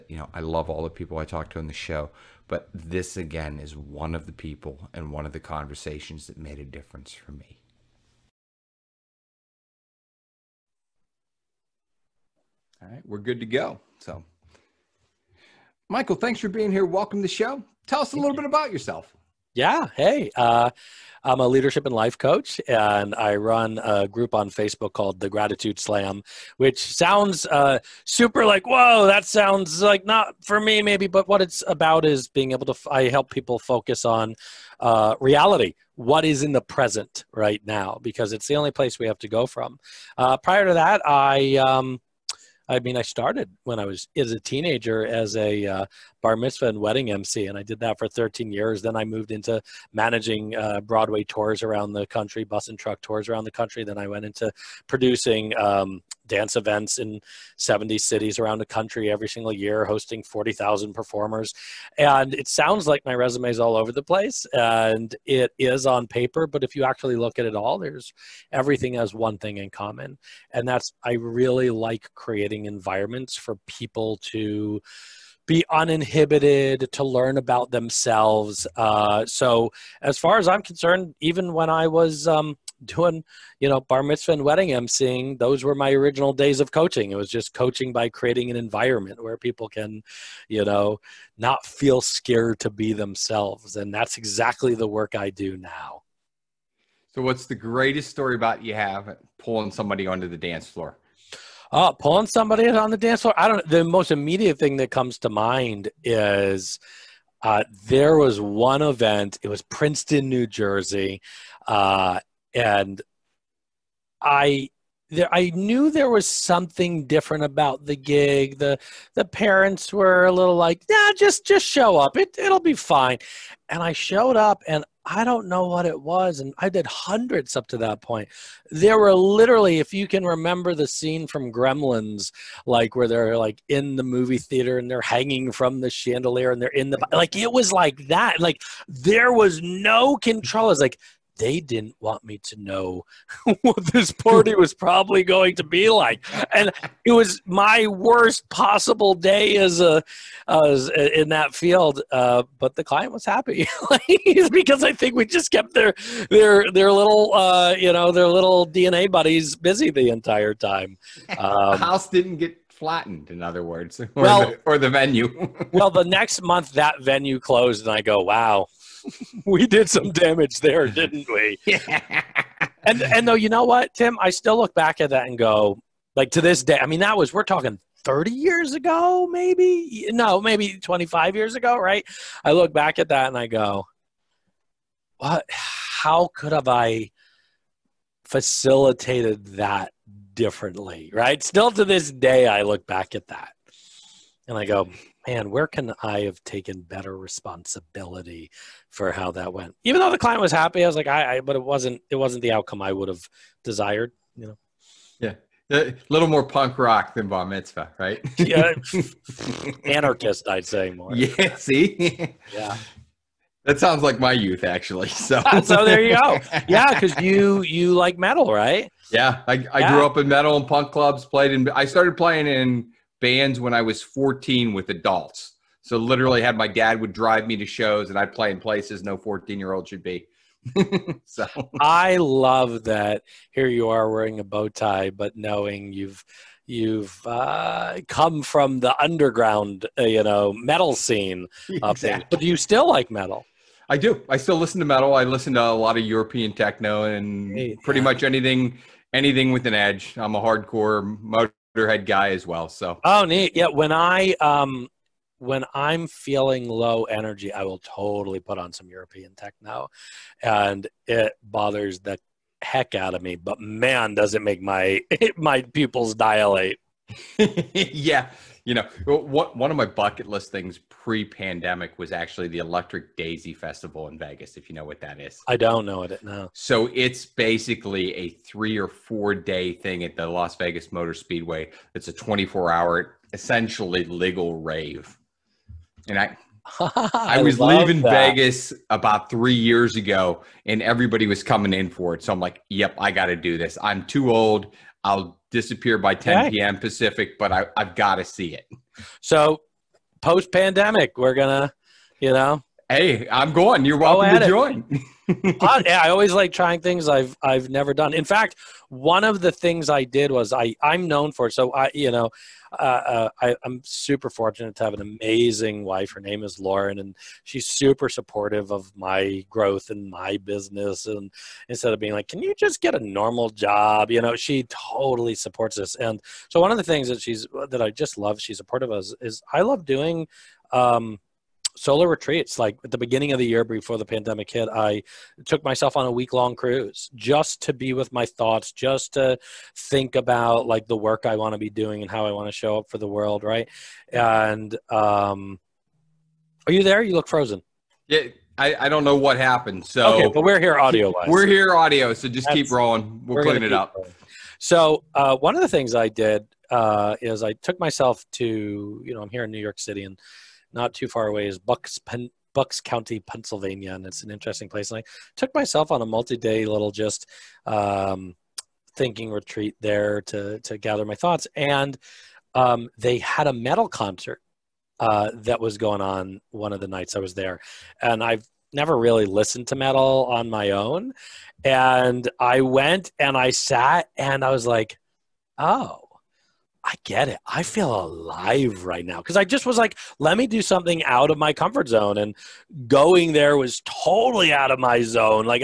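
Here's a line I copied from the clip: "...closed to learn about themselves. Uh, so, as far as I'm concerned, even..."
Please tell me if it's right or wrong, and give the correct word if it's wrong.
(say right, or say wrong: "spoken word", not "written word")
wrong: "uninhibited", not "closed".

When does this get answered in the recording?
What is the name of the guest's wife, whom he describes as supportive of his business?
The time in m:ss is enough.
5:16.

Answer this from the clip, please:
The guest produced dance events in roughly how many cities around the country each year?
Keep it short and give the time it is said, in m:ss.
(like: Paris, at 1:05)
70, at 0:57.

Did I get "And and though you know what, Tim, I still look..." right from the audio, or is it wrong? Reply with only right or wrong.
right.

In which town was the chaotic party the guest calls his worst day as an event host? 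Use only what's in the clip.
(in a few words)
Princeton, New Jersey.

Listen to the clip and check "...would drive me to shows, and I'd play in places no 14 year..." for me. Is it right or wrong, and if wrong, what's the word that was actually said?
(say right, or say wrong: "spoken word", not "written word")
right.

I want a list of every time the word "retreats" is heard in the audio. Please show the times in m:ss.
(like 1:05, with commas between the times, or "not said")
5:32, 6:09.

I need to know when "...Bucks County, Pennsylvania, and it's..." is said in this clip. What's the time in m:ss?
6:02.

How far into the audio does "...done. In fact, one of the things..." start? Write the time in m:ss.
5:07.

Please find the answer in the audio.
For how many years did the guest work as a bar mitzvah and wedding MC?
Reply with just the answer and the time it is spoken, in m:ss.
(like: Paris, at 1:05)
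13, at 0:48.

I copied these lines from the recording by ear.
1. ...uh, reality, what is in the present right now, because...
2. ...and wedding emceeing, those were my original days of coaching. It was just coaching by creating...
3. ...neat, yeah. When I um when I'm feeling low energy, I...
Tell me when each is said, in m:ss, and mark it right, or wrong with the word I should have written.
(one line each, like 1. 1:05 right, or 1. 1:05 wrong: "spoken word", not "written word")
1. 0:34 right
2. 1:24 right
3. 4:13 right.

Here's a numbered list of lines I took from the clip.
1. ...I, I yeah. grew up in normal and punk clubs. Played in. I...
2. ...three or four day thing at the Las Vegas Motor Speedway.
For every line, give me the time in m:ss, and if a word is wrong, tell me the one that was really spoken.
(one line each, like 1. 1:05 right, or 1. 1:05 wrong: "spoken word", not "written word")
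1. 3:39 wrong: "metal", not "normal"
2. 4:38 right.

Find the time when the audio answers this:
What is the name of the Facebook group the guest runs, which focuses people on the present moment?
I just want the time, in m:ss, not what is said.
0:25.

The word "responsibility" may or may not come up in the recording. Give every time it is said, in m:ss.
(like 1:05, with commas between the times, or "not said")
3:17.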